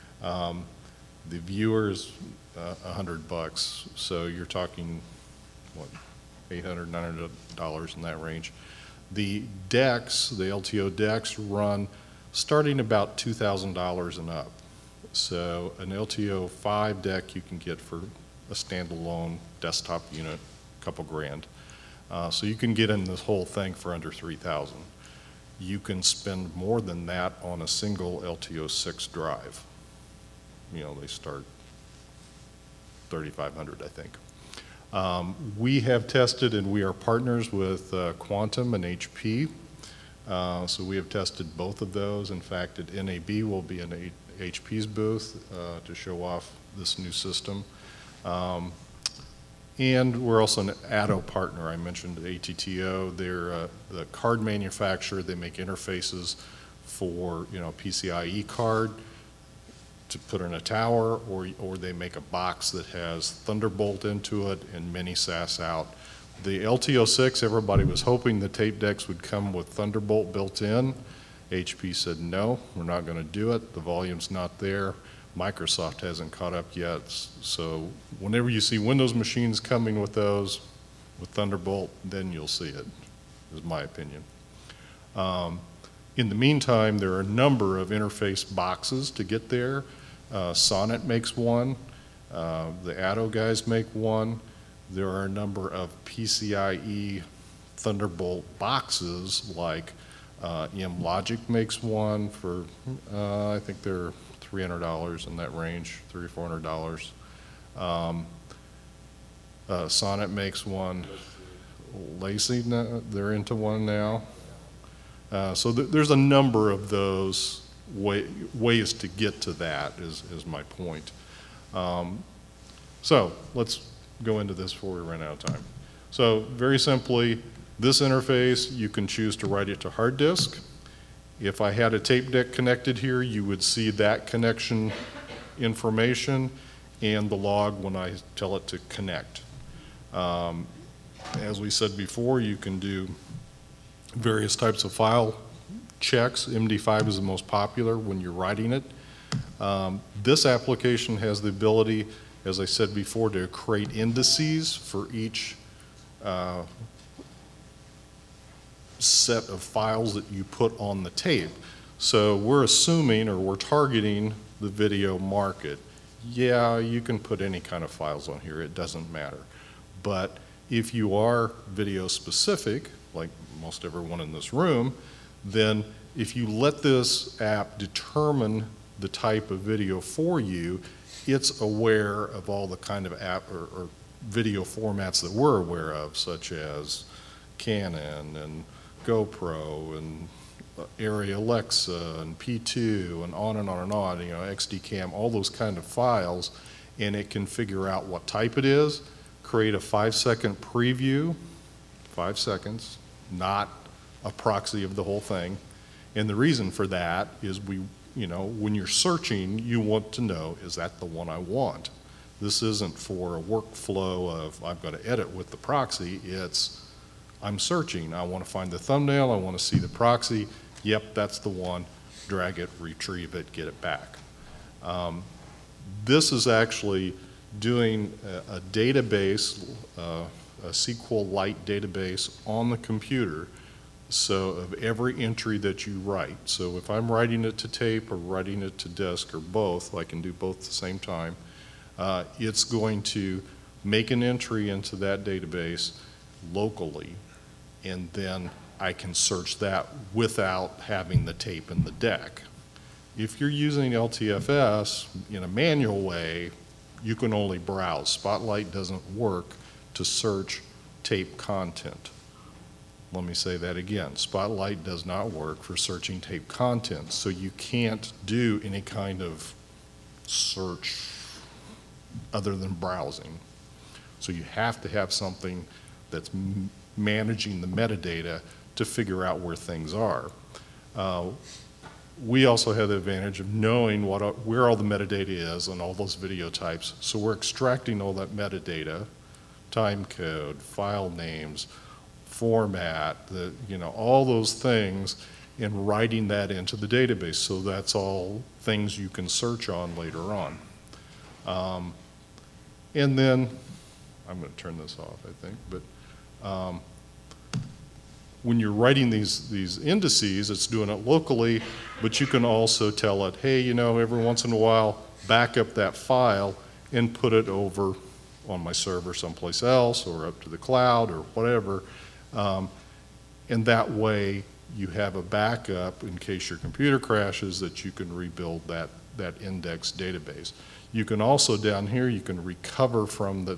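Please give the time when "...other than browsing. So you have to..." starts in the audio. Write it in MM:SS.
04:32.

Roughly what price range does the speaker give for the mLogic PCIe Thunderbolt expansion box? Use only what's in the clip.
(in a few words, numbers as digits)
$300 to $400.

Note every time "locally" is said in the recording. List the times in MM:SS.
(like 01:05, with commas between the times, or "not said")
04:06, 05:11.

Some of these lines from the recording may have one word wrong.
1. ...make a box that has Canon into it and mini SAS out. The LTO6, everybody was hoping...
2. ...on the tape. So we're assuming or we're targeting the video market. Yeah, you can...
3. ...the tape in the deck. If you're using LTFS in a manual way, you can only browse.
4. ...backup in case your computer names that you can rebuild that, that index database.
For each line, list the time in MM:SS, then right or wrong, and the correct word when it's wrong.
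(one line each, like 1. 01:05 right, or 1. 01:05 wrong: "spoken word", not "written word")
1. 01:01 wrong: "Thunderbolt", not "Canon"
2. 02:40 right
3. 04:11 right
4. 05:25 wrong: "crashes", not "names".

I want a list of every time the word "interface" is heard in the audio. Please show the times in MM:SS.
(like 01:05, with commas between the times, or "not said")
00:55, 01:27, 02:08.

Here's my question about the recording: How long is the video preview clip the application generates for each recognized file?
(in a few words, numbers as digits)
5 seconds.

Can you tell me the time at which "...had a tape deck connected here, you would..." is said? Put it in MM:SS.
02:11.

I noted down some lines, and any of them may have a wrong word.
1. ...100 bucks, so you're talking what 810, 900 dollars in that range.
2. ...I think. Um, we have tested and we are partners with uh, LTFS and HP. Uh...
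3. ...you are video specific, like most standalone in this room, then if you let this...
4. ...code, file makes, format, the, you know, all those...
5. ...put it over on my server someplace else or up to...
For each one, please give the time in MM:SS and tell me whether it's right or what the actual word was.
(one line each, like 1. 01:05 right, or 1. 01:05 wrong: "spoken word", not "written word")
1. 00:02 wrong: "800", not "810"
2. 00:33 wrong: "Quantum", not "LTFS"
3. 02:50 wrong: "everyone", not "standalone"
4. 04:50 wrong: "names", not "makes"
5. 05:17 right.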